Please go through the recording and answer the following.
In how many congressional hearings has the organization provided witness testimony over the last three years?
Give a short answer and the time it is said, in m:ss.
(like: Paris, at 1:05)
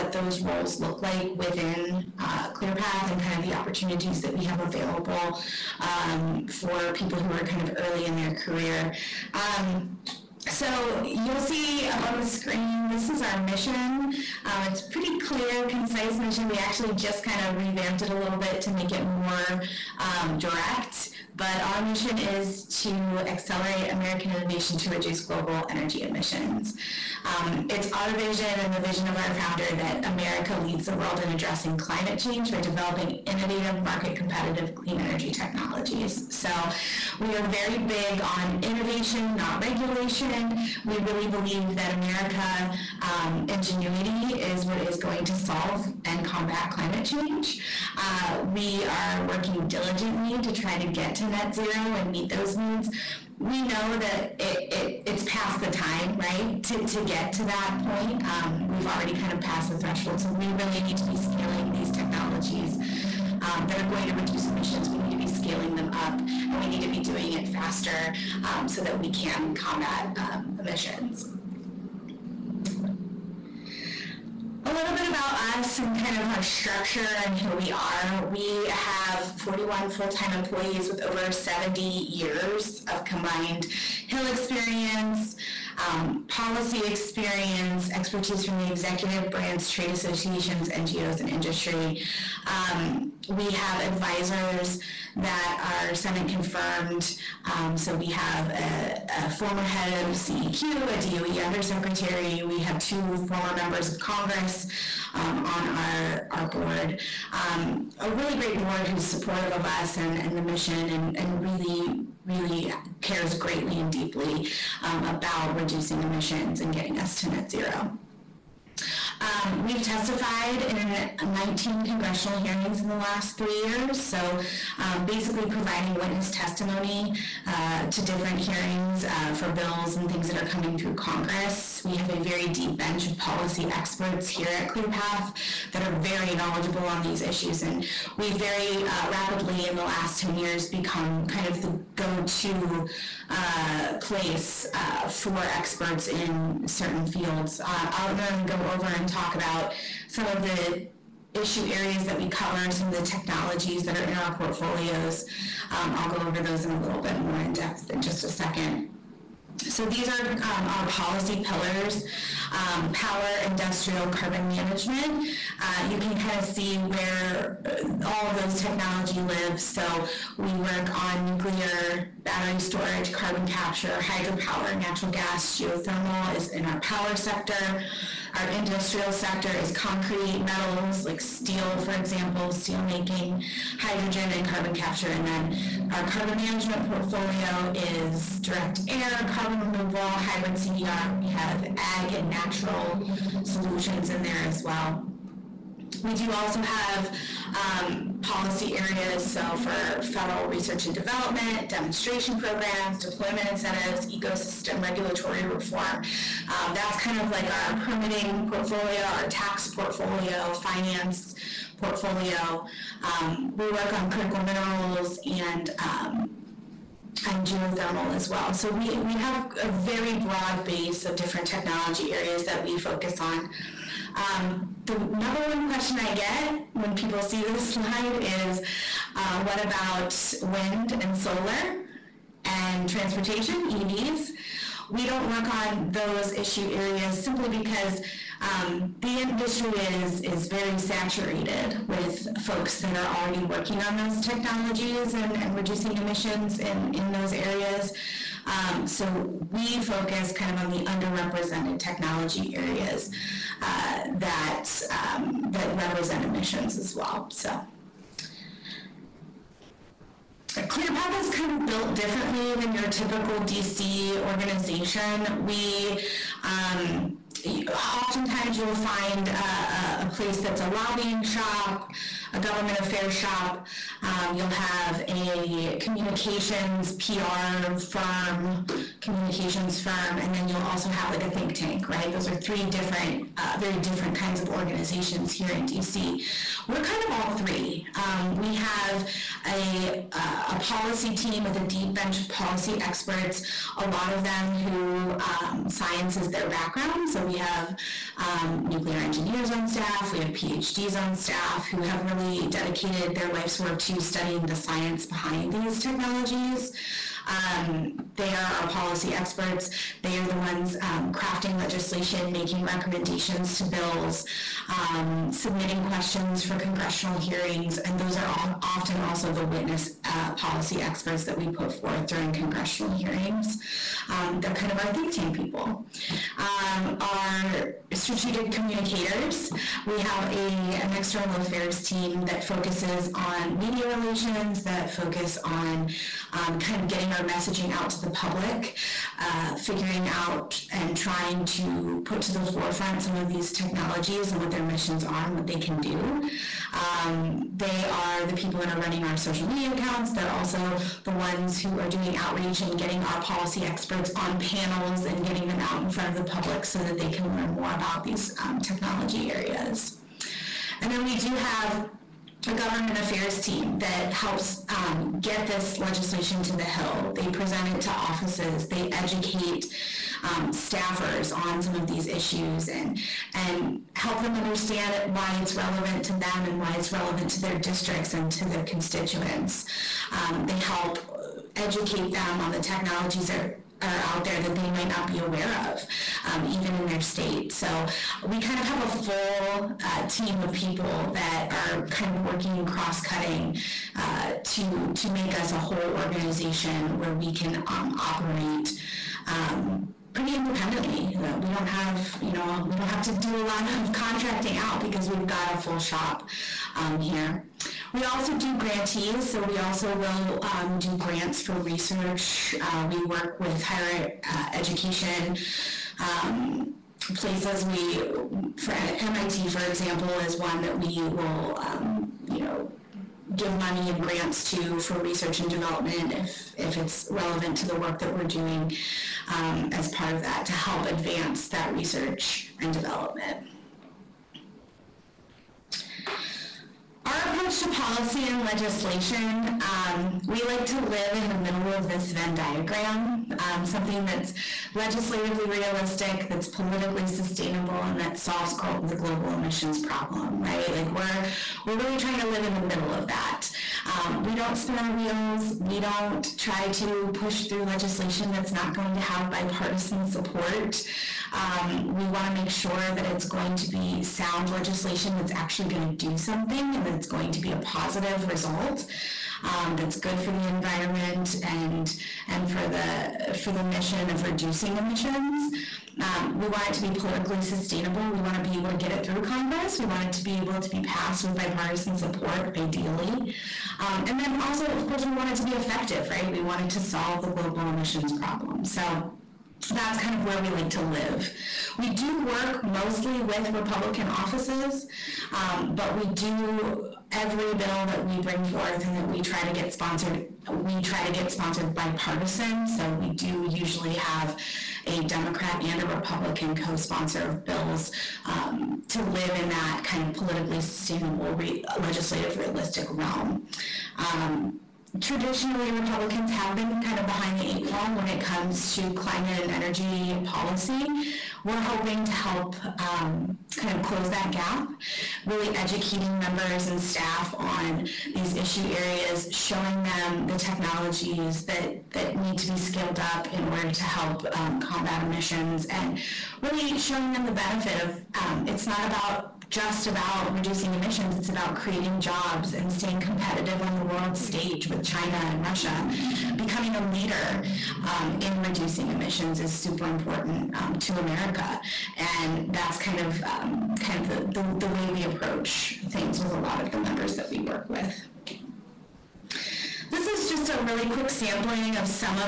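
19, at 2:01.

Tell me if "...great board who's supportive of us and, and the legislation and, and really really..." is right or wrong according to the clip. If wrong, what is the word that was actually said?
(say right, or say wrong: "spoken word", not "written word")
wrong: "mission", not "legislation".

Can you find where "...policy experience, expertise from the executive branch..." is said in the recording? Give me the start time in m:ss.
1:26.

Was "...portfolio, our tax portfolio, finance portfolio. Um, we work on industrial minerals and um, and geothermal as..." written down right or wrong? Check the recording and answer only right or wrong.
wrong.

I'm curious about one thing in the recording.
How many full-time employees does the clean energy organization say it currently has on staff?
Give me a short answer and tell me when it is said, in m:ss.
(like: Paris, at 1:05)
41, at 1:19.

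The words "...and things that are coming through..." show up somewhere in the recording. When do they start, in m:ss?
2:09.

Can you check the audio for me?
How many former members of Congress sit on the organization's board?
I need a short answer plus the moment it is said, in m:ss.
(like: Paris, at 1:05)
2, at 1:42.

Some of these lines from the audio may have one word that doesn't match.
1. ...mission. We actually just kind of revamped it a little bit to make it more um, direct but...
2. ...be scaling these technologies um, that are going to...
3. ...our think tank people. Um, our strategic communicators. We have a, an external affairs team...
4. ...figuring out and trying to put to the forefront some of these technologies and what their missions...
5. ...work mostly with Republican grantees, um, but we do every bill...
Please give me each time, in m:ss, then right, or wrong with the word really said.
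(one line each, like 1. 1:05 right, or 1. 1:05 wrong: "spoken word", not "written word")
1. 0:16 right
2. 1:01 right
3. 5:24 right
4. 5:39 right
5. 8:12 wrong: "offices", not "grantees".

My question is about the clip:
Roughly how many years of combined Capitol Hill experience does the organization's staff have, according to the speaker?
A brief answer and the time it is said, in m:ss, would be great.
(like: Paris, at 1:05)
70, at 1:21.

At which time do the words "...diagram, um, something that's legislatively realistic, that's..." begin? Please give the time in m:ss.
7:22.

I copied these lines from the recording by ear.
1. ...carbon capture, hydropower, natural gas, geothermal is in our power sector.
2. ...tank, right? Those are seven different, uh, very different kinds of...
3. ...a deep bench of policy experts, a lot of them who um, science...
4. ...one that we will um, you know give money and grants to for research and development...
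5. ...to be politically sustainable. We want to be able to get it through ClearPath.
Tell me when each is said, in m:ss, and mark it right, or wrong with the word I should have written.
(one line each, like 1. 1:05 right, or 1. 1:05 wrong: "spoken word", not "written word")
1. 2:53 right
2. 4:41 wrong: "three", not "seven"
3. 4:51 right
4. 7:00 right
5. 7:56 wrong: "Congress", not "ClearPath".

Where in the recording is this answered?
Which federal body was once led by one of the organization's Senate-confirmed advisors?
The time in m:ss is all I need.
1:40.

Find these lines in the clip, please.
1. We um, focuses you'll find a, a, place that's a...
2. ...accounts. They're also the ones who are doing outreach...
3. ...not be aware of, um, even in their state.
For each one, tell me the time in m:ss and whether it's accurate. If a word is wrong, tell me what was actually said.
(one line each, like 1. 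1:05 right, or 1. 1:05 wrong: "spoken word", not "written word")
1. 4:25 wrong: "oftentimes", not "focuses"
2. 5:49 right
3. 6:24 right.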